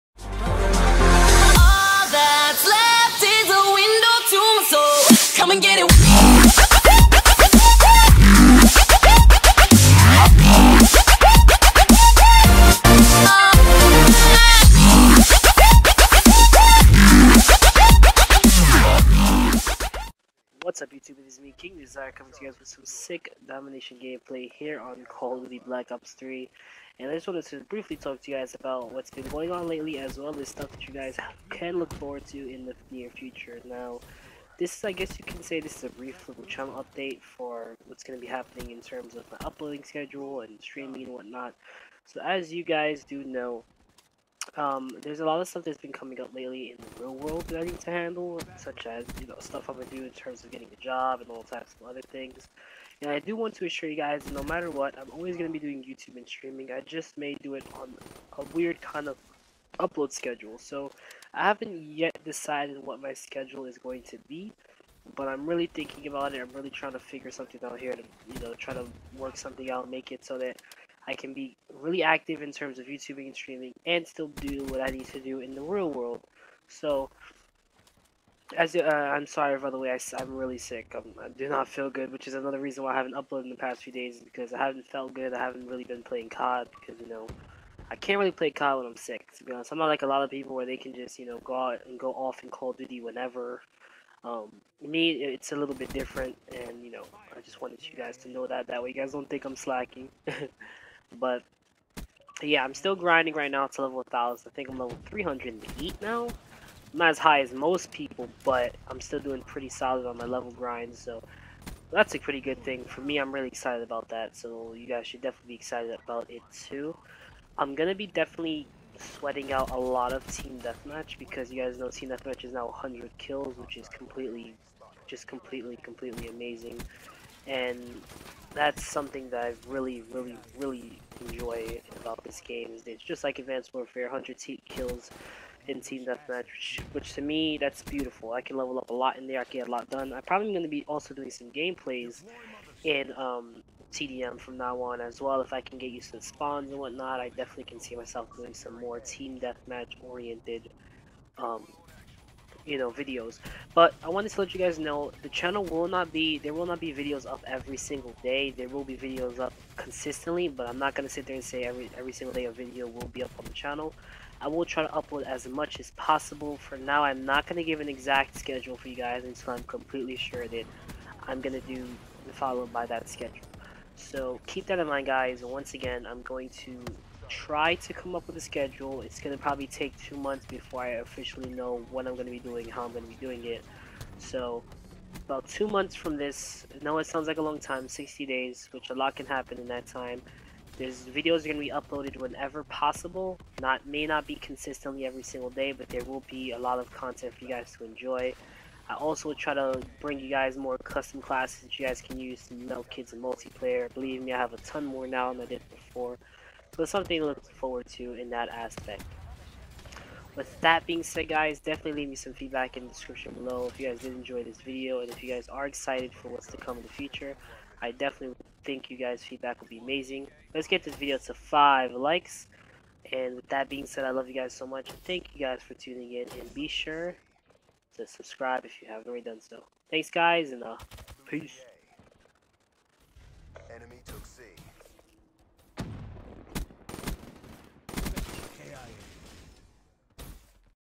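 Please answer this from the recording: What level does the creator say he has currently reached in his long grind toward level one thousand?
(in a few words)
308.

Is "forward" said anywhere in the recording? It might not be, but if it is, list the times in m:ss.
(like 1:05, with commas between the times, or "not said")
0:31, 3:27.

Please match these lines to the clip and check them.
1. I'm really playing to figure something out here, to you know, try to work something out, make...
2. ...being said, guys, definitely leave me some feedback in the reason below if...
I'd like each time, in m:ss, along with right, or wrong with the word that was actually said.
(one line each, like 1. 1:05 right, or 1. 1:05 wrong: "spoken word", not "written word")
1. 1:06 wrong: "trying", not "playing"
2. 3:30 wrong: "description", not "reason".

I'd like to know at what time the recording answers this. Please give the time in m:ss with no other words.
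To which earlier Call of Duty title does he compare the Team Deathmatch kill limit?
2:13.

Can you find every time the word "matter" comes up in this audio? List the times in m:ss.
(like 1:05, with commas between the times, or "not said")
0:54.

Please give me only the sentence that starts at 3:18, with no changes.
I also try to bring you guys more custom classes that you guys can use to melt kids in multiplayer.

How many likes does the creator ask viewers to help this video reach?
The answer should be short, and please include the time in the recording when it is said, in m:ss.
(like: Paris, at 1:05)
5, at 3:41.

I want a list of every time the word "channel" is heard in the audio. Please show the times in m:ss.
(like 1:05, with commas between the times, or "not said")
0:36, 2:35, 2:43.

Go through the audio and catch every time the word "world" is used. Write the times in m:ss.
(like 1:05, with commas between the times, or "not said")
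0:47, 1:15.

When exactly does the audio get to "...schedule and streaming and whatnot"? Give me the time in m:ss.
0:39.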